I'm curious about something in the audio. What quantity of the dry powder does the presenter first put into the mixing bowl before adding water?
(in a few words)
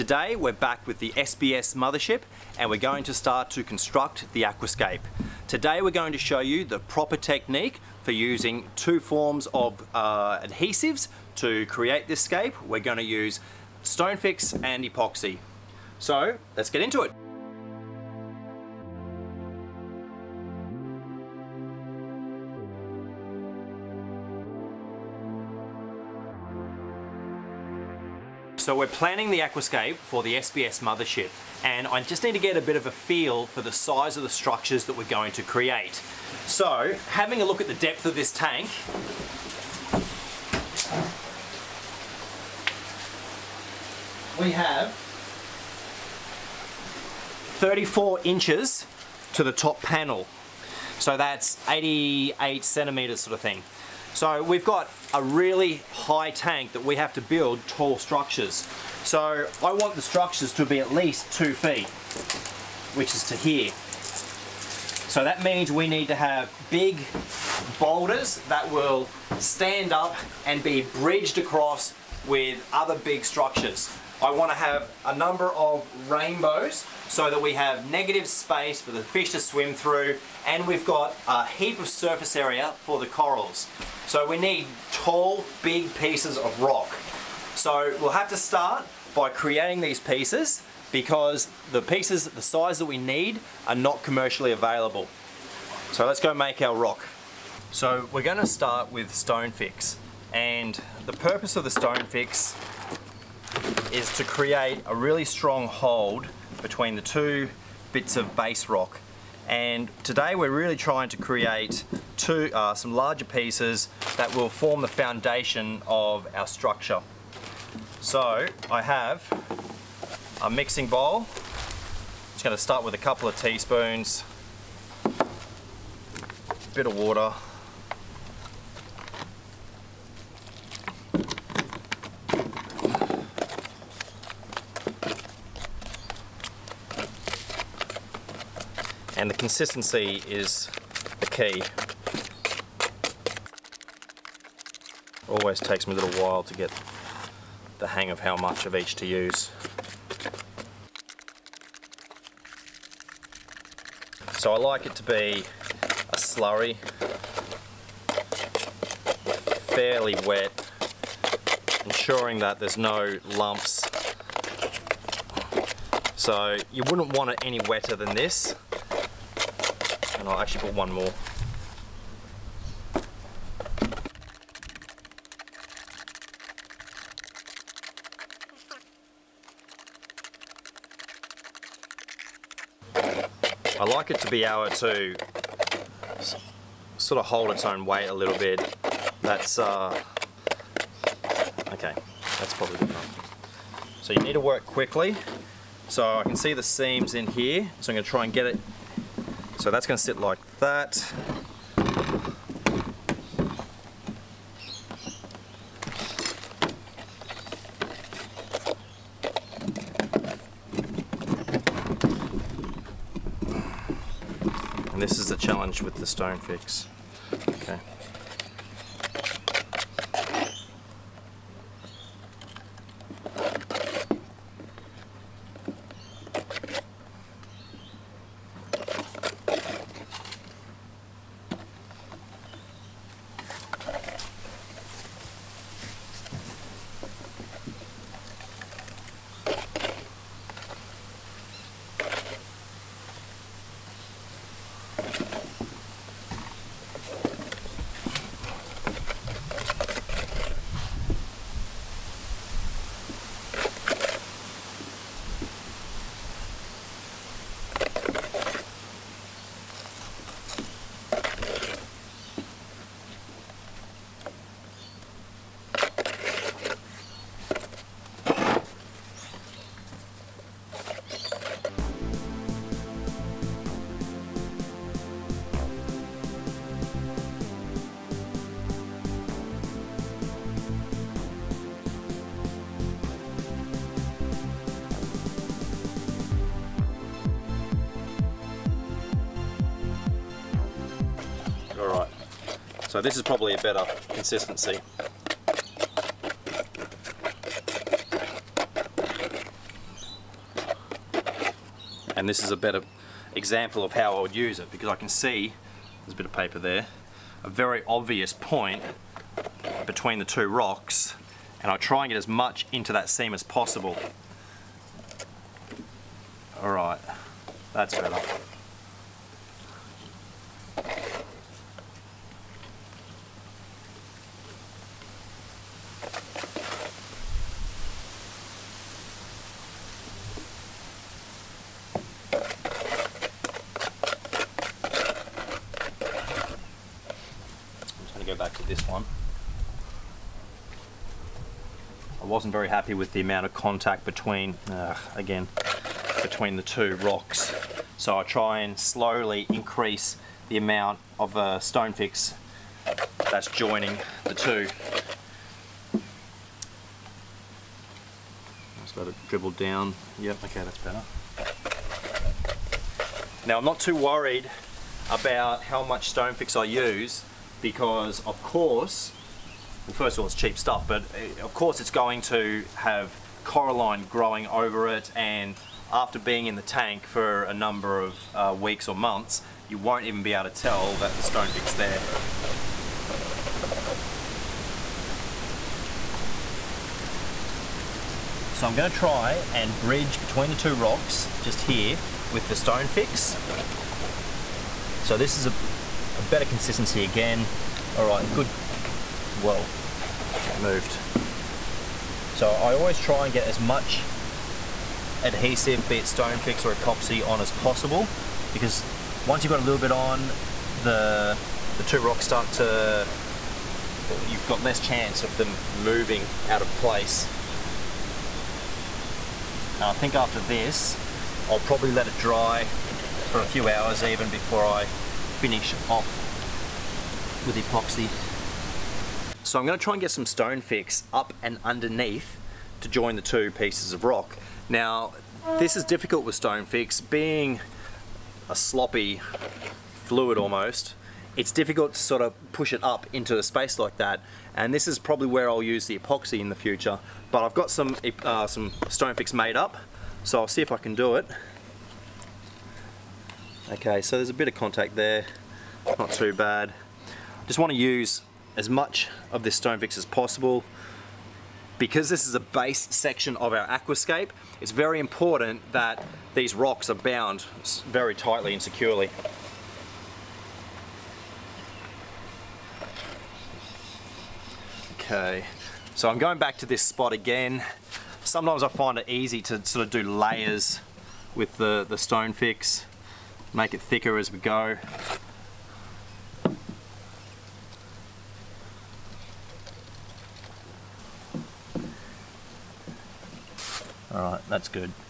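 A couple of teaspoons.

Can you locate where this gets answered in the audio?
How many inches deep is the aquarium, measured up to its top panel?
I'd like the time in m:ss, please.
0:47.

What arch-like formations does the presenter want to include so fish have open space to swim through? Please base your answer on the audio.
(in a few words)
Rainbows.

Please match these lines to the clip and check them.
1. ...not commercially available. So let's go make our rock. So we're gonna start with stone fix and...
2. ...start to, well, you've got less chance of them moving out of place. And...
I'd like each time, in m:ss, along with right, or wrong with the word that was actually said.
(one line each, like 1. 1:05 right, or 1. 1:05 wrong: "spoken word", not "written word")
1. 1:33 right
2. 6:52 right.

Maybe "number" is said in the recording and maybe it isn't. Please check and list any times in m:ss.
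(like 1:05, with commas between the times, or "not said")
1:15, 6:17.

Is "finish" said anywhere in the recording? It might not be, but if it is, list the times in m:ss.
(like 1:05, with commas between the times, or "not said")
7:05.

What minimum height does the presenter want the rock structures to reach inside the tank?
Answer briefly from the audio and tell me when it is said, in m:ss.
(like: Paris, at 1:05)
2 feet, at 1:01.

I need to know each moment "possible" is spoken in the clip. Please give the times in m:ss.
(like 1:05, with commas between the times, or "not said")
5:13, 6:47, 7:40.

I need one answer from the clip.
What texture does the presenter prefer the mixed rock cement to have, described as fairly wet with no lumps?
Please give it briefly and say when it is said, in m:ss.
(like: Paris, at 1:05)
A slurry, at 2:36.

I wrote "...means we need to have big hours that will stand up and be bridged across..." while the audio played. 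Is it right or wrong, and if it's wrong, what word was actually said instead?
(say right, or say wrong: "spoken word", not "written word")
wrong: "boulders", not "hours".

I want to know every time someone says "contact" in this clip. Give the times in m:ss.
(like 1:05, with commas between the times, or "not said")
5:43, 7:34.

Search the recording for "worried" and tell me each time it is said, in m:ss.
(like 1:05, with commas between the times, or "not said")
6:03.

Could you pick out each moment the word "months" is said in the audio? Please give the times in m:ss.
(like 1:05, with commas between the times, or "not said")
6:18.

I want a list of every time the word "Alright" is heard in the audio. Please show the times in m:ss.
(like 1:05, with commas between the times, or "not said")
5:16, 8:14.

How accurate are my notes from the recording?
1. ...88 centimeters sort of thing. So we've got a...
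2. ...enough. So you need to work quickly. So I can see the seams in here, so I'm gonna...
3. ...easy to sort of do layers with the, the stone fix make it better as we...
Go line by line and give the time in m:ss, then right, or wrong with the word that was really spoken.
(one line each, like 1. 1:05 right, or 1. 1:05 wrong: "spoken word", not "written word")
1. 0:51 right
2. 3:12 right
3. 7:59 wrong: "thicker", not "better".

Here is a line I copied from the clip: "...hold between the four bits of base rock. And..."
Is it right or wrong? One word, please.
wrong.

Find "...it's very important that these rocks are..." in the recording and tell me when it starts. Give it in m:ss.
7:44.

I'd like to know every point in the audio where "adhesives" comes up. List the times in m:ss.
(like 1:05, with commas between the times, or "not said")
0:10, 6:45.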